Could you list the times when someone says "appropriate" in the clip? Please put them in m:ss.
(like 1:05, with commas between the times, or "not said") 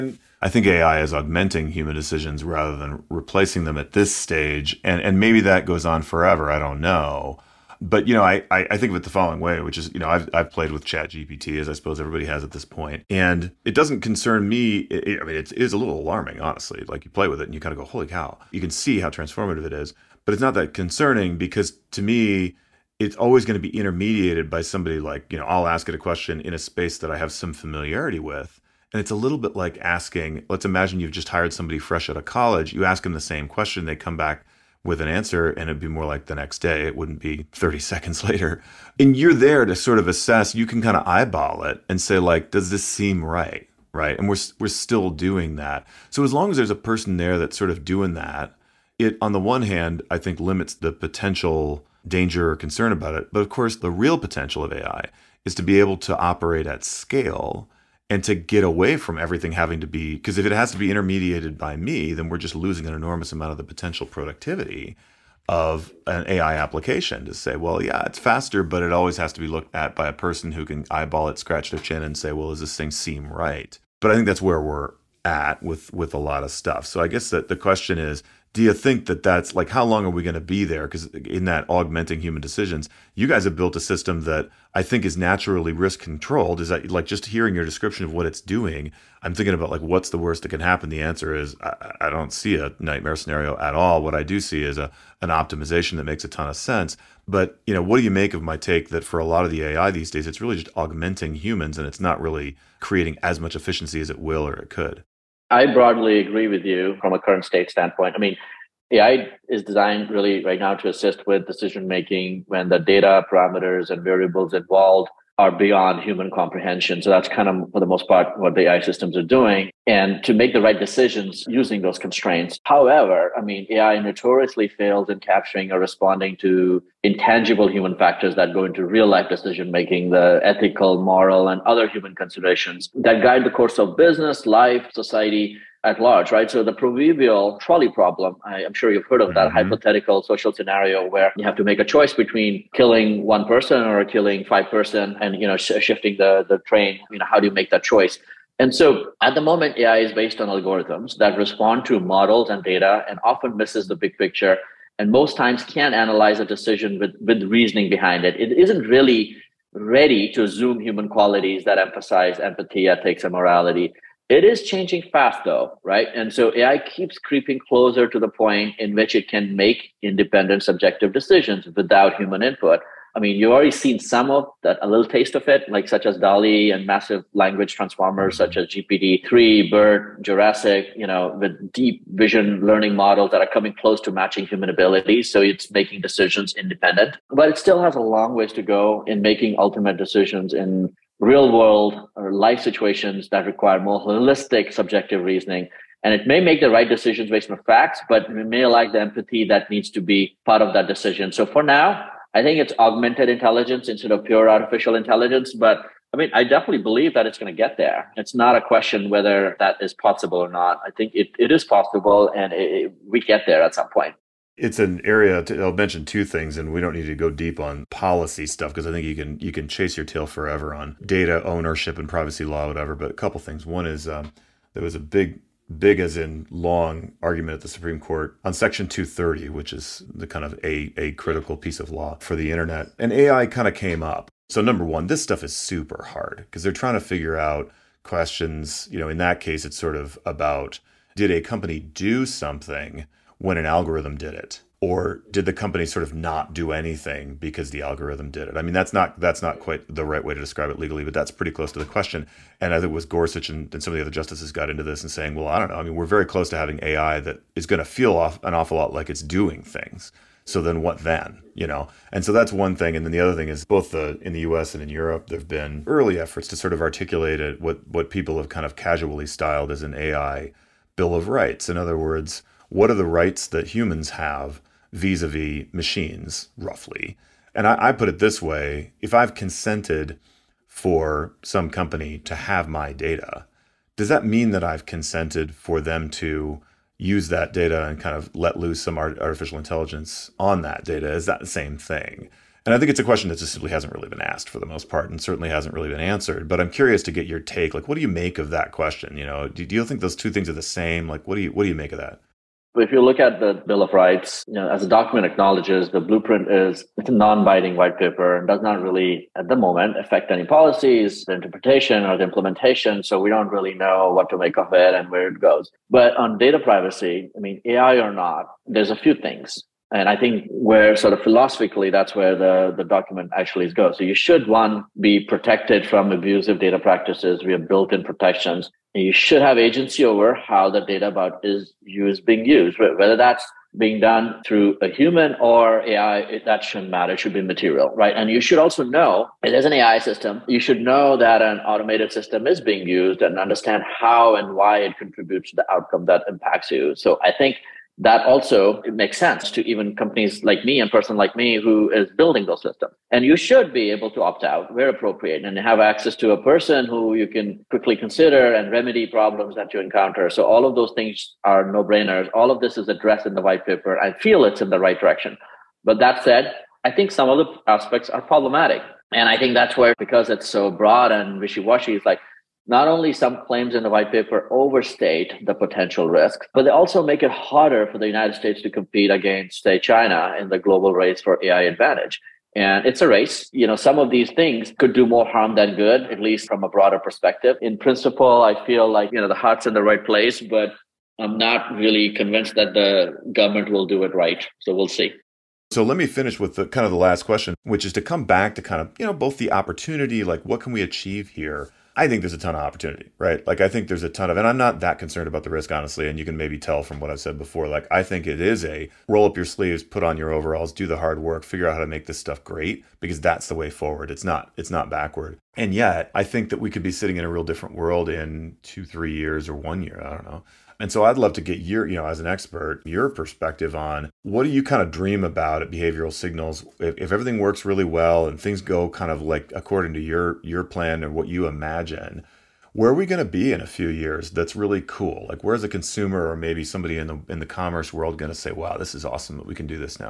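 5:54.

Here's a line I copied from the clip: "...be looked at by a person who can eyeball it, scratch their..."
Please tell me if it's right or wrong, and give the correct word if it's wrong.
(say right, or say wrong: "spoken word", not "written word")
right.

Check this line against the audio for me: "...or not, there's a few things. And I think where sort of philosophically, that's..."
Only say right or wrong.
right.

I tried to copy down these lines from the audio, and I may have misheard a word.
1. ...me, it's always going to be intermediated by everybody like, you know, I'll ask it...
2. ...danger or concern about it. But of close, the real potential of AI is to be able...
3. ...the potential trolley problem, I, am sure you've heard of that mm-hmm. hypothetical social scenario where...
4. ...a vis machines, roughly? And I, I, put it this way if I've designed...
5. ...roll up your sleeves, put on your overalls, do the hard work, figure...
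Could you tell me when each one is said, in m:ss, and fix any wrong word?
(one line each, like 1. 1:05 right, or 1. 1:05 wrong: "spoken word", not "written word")
1. 0:22 wrong: "somebody", not "everybody"
2. 0:52 wrong: "course", not "close"
3. 2:16 wrong: "proverbial", not "potential"
4. 4:35 wrong: "consented", not "designed"
5. 6:49 right.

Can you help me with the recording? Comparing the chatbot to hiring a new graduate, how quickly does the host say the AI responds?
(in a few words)
30 seconds.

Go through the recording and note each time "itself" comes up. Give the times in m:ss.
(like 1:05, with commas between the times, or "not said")
not said.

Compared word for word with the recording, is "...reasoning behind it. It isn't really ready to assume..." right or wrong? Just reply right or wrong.
right.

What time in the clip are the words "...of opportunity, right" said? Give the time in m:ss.
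6:42.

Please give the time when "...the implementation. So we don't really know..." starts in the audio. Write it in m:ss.
5:12.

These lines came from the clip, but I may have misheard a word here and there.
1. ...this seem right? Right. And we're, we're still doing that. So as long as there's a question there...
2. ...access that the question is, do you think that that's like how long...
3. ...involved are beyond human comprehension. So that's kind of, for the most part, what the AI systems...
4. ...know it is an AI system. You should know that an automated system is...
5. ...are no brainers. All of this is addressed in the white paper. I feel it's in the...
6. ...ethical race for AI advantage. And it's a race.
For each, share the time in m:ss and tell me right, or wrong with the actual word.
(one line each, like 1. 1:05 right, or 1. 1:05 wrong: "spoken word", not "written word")
1. 0:42 wrong: "person", not "question"
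2. 1:17 wrong: "guess", not "access"
3. 1:54 right
4. 5:38 right
5. 6:01 right
6. 6:20 wrong: "global", not "ethical".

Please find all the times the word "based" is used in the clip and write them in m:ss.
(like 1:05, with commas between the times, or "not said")
2:30, 3:17.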